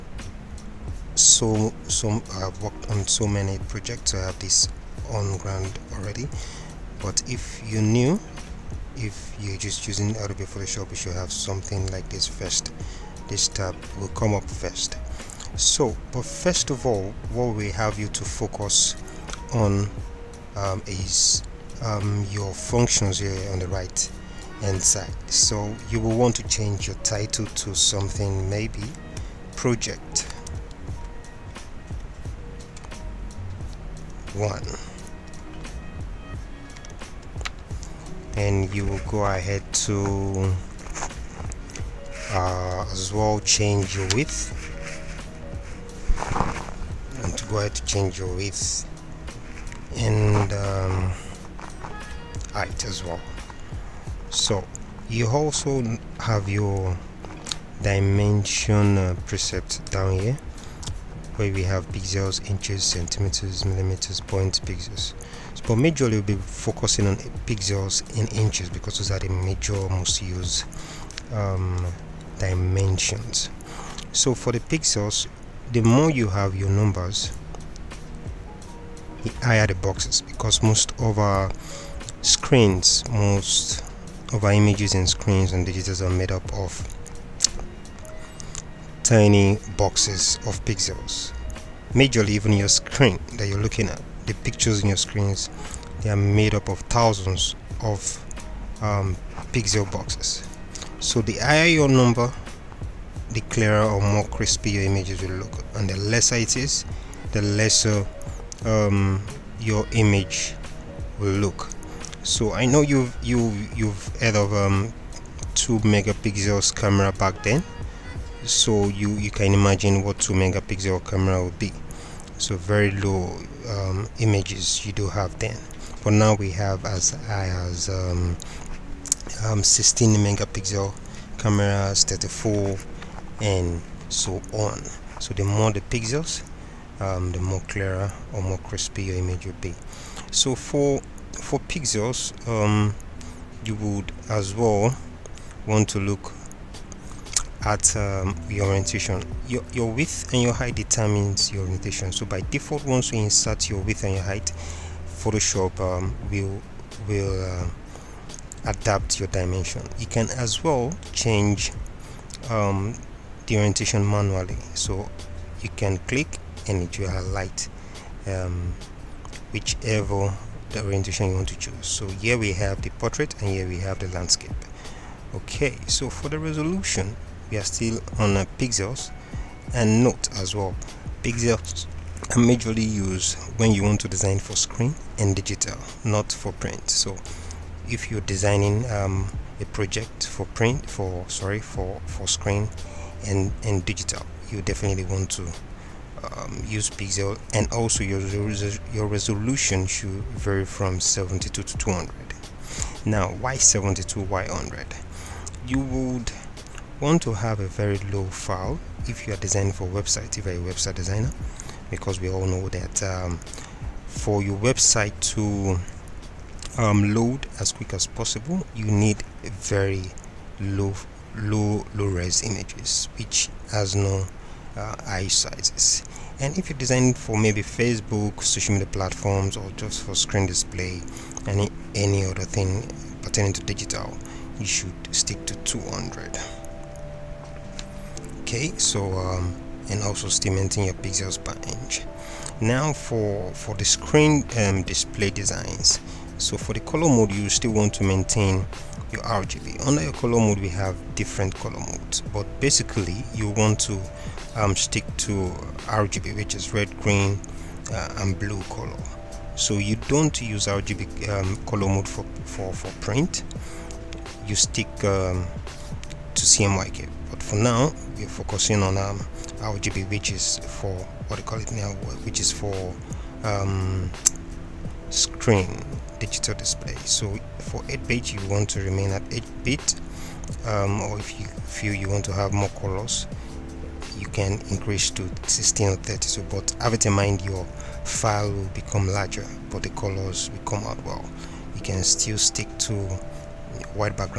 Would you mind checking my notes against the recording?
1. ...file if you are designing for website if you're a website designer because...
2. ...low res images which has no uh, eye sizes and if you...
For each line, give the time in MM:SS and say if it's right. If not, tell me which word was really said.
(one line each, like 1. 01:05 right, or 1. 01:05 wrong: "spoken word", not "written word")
1. 03:28 right
2. 03:41 right.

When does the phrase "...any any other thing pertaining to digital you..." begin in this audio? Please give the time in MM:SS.
03:51.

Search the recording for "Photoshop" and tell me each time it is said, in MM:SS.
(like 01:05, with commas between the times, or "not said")
00:10, 02:35.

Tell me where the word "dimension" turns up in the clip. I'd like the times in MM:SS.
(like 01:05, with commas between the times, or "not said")
00:57, 01:12, 02:39.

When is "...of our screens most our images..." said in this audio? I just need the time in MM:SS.
01:21.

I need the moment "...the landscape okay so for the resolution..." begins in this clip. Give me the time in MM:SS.
02:53.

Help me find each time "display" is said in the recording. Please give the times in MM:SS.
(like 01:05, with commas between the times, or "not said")
03:50, 04:04, 04:36.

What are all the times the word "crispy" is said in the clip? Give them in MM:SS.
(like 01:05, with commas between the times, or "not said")
01:44, 02:18.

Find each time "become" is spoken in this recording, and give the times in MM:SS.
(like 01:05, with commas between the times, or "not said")
04:48.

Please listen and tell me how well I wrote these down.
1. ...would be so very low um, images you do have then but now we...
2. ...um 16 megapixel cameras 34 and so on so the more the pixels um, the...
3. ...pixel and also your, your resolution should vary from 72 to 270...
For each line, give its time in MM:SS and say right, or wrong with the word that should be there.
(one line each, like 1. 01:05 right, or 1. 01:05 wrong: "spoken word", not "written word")
1. 02:01 right
2. 02:09 right
3. 03:16 wrong: "200", not "270".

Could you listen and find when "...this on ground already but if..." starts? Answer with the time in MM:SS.
00:04.